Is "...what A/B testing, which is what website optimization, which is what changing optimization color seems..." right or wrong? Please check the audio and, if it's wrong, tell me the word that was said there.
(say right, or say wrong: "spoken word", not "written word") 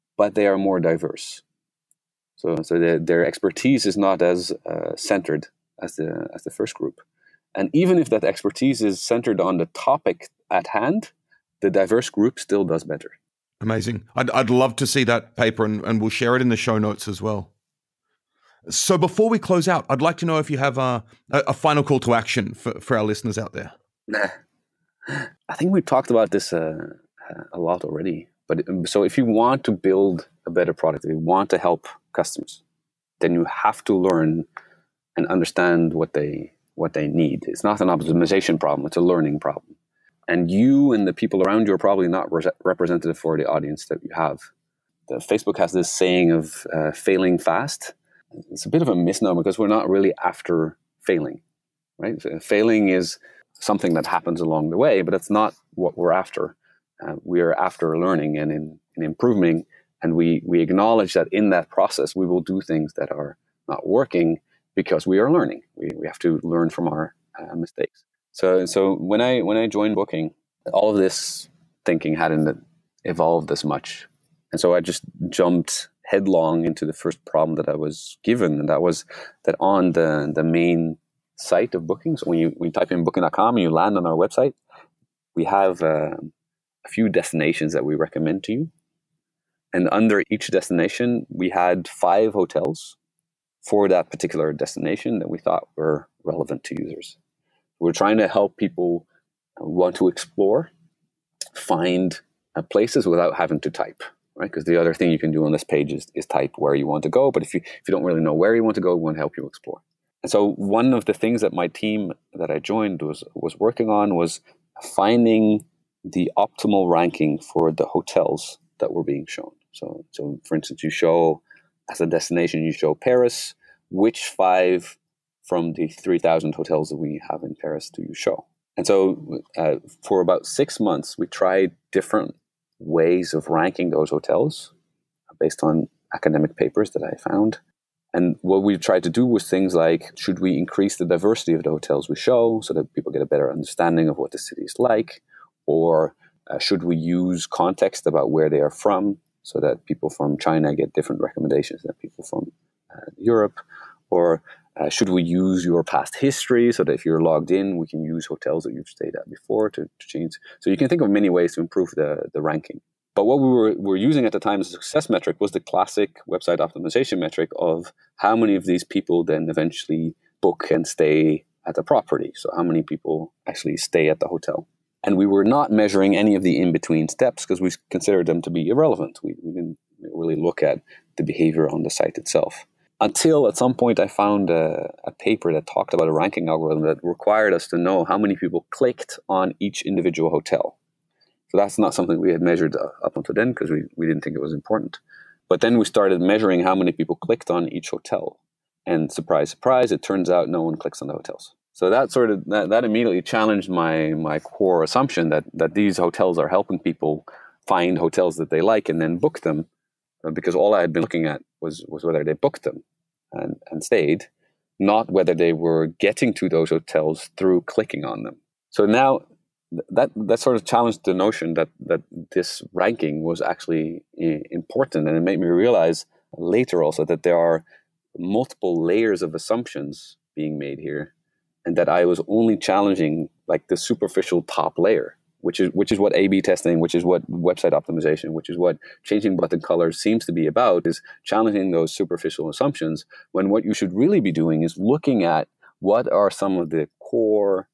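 wrong: "button", not "optimization".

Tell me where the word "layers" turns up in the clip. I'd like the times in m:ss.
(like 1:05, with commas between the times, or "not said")
3:48, 3:54.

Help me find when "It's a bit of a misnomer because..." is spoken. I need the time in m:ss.
0:48.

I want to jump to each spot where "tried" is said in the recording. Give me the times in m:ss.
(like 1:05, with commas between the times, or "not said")
2:11, 2:18.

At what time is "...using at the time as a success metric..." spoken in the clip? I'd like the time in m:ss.
2:43.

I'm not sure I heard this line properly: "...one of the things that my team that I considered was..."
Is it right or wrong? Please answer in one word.
wrong.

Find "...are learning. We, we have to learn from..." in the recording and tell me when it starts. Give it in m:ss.
1:05.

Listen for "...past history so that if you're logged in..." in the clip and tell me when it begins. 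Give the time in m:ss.
2:35.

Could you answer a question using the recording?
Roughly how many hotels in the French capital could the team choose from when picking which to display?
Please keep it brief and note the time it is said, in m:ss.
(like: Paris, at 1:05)
3,000, at 2:05.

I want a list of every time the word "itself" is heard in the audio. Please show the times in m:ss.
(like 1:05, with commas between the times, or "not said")
3:02.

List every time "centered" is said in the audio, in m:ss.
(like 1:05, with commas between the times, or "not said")
0:04, 0:09.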